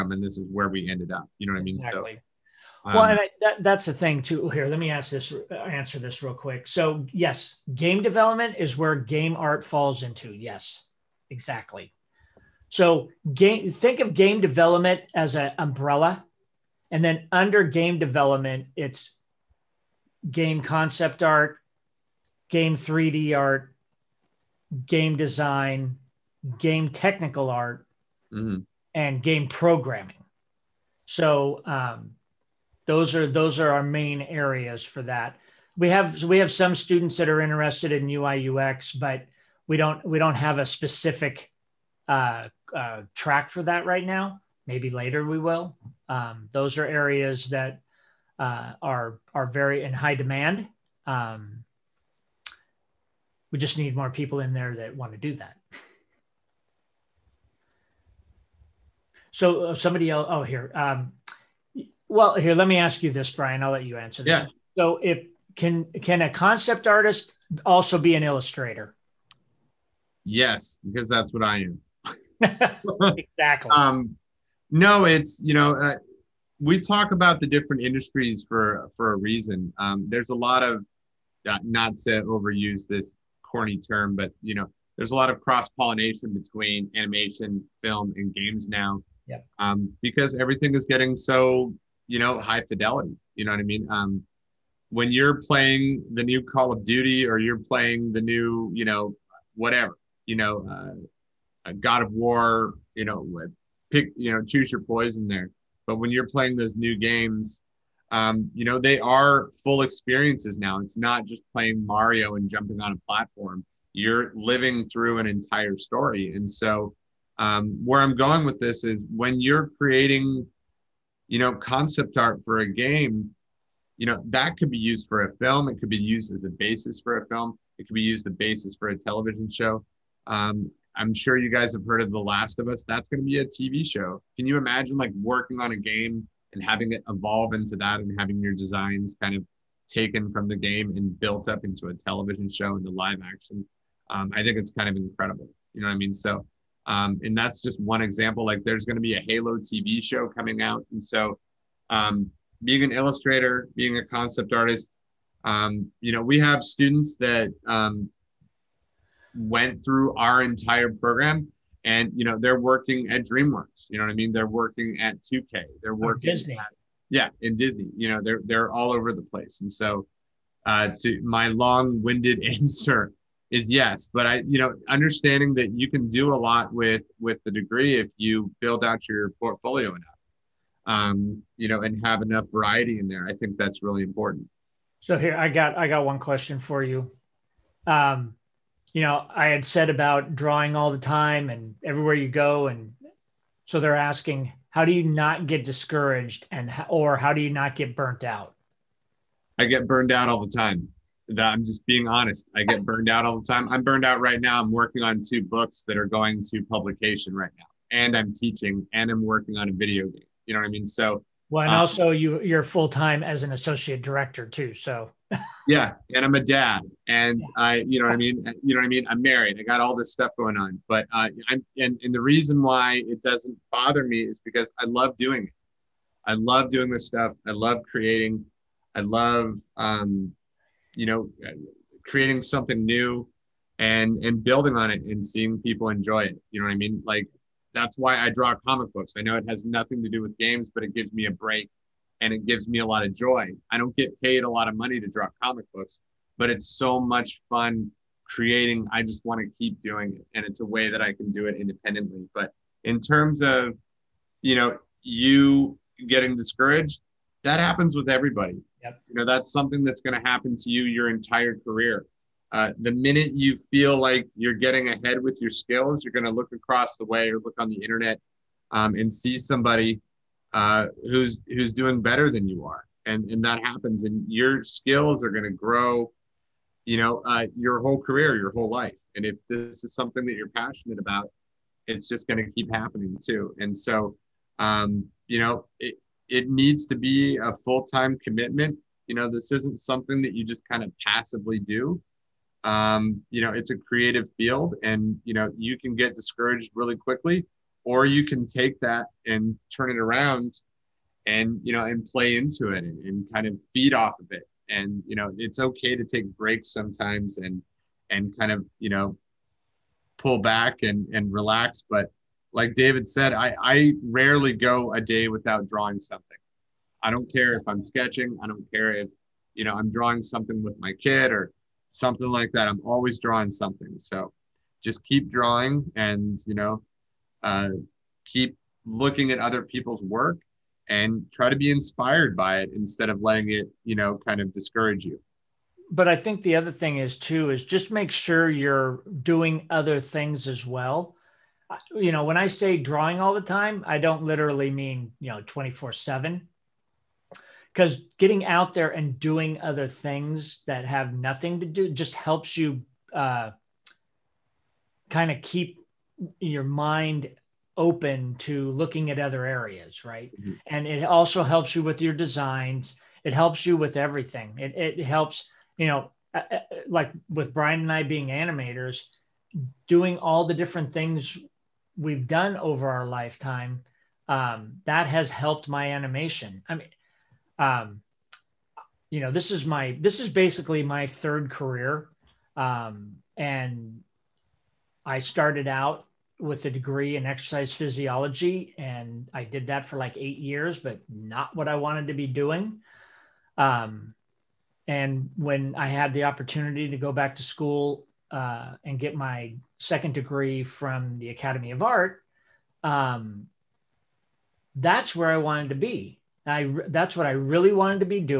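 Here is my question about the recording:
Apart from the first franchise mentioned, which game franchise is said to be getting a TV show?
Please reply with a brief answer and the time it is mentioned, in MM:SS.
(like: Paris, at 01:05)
Halo, at 02:29.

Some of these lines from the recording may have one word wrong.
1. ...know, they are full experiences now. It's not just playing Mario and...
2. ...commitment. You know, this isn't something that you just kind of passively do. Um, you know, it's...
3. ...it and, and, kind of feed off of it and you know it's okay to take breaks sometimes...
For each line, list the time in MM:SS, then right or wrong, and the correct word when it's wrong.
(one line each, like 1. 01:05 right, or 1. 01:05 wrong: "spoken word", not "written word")
1. 01:48 right
2. 04:48 right
3. 05:02 right.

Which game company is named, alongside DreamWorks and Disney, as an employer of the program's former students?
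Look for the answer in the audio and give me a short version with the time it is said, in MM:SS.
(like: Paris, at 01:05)
2K, at 02:45.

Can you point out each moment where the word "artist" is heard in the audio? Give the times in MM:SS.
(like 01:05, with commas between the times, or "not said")
01:06, 02:34.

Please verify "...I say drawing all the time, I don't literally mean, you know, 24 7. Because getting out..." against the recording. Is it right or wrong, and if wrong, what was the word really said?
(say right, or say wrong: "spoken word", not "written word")
right.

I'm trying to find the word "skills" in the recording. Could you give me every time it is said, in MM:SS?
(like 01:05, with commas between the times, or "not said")
04:25, 04:34.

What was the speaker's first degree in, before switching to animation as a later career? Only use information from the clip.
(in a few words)
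Exercise physiology.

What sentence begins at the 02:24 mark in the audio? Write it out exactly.
Um, I think it's kind of incredible.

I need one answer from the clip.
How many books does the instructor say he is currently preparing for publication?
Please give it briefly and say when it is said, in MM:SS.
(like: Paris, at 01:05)
2, at 03:25.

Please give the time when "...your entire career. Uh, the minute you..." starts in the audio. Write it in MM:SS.
04:20.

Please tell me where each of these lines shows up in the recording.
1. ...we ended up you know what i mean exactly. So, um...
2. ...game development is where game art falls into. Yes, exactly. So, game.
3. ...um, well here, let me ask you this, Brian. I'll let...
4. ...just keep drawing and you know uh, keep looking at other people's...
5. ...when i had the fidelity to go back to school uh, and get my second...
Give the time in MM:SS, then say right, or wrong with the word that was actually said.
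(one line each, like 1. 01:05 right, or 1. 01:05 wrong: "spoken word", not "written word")
1. 00:00 right
2. 00:07 right
3. 01:00 right
4. 05:24 right
5. 06:35 wrong: "opportunity", not "fidelity".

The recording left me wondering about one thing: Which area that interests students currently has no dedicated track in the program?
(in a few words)
UI UX.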